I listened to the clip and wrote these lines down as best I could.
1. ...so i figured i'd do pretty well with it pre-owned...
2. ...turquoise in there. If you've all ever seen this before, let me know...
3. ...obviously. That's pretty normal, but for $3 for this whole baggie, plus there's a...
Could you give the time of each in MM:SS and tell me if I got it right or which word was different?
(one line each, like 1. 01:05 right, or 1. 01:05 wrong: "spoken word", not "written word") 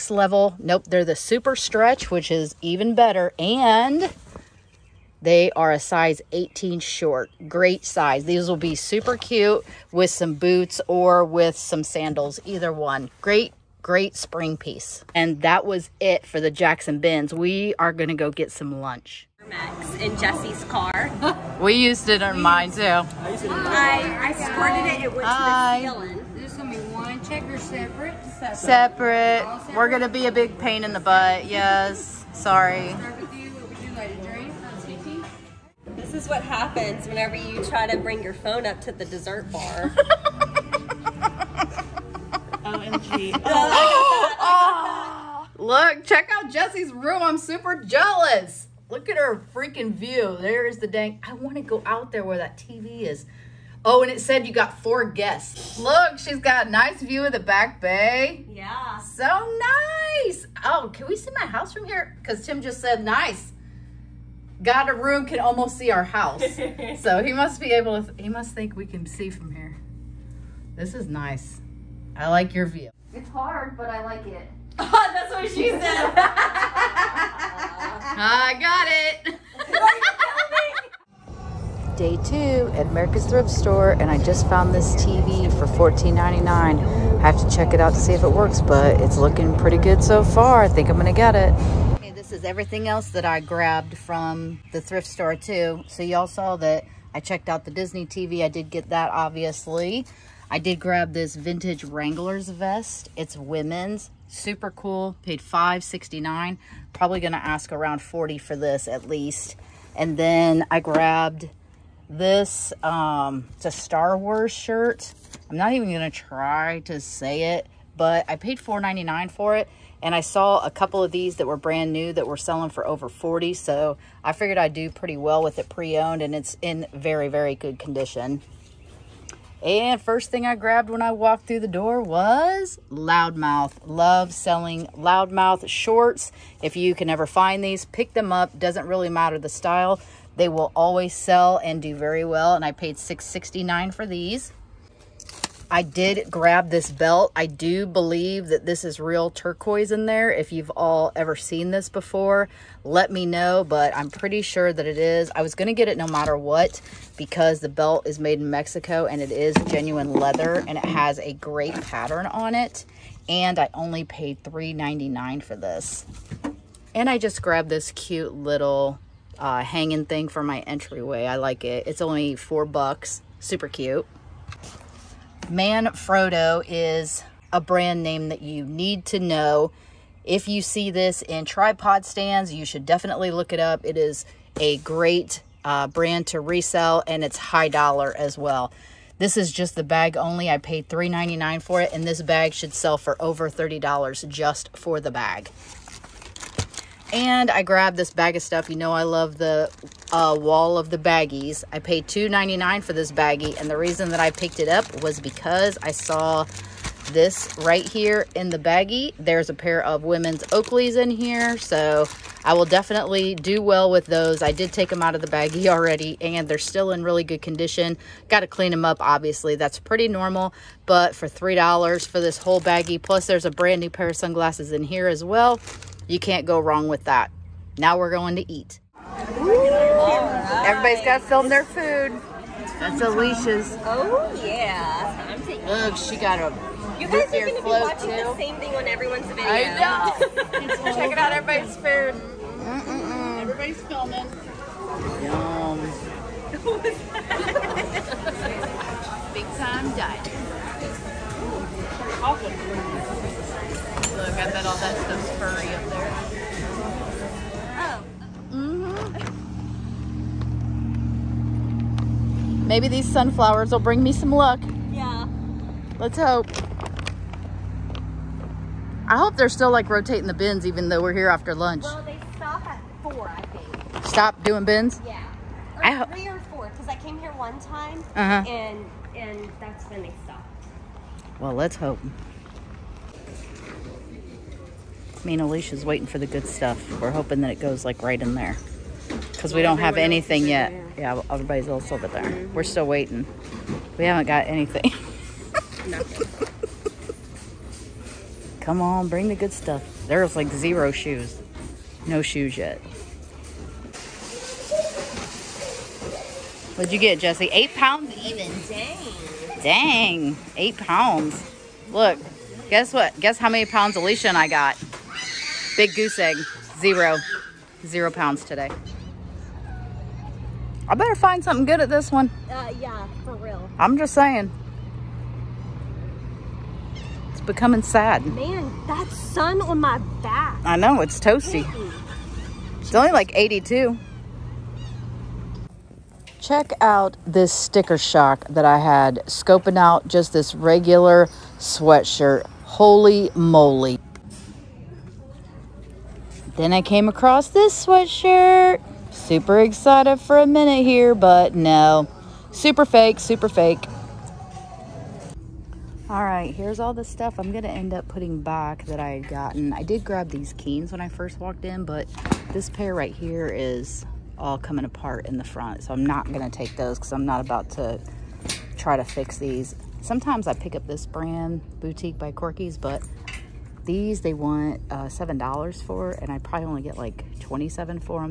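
1. 02:03 right
2. 02:29 right
3. 03:39 right.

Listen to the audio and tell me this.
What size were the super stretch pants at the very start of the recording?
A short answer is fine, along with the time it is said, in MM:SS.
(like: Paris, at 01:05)
18 short, at 00:05.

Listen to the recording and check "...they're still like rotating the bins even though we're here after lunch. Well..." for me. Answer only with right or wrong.
right.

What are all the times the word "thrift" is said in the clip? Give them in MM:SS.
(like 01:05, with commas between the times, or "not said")
01:23, 01:34.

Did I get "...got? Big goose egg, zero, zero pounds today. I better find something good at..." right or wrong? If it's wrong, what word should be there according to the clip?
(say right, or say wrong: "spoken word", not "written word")
right.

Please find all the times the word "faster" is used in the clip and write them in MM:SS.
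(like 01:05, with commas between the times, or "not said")
not said.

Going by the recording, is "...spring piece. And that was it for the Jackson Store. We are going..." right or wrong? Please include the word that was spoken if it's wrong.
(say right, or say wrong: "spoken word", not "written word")
wrong: "Bins", not "Store".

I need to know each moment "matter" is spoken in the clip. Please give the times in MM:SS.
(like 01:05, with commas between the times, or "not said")
02:19, 02:36.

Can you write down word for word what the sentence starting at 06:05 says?
So I'm not gonna take those because I'm not about to try to fix these.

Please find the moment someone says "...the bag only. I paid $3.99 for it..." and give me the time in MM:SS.
03:09.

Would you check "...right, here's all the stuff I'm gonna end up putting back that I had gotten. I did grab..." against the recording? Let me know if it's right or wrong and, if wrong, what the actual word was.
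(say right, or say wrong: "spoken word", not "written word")
right.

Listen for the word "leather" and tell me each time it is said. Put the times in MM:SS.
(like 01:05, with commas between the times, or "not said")
02:40.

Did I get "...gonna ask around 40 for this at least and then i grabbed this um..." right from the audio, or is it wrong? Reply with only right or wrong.
right.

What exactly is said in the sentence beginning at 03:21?
I paid $2.99 for this baggie.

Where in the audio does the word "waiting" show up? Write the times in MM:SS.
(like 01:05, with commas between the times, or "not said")
04:45, 04:52.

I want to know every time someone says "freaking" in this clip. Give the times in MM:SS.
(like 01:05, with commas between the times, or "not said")
00:49.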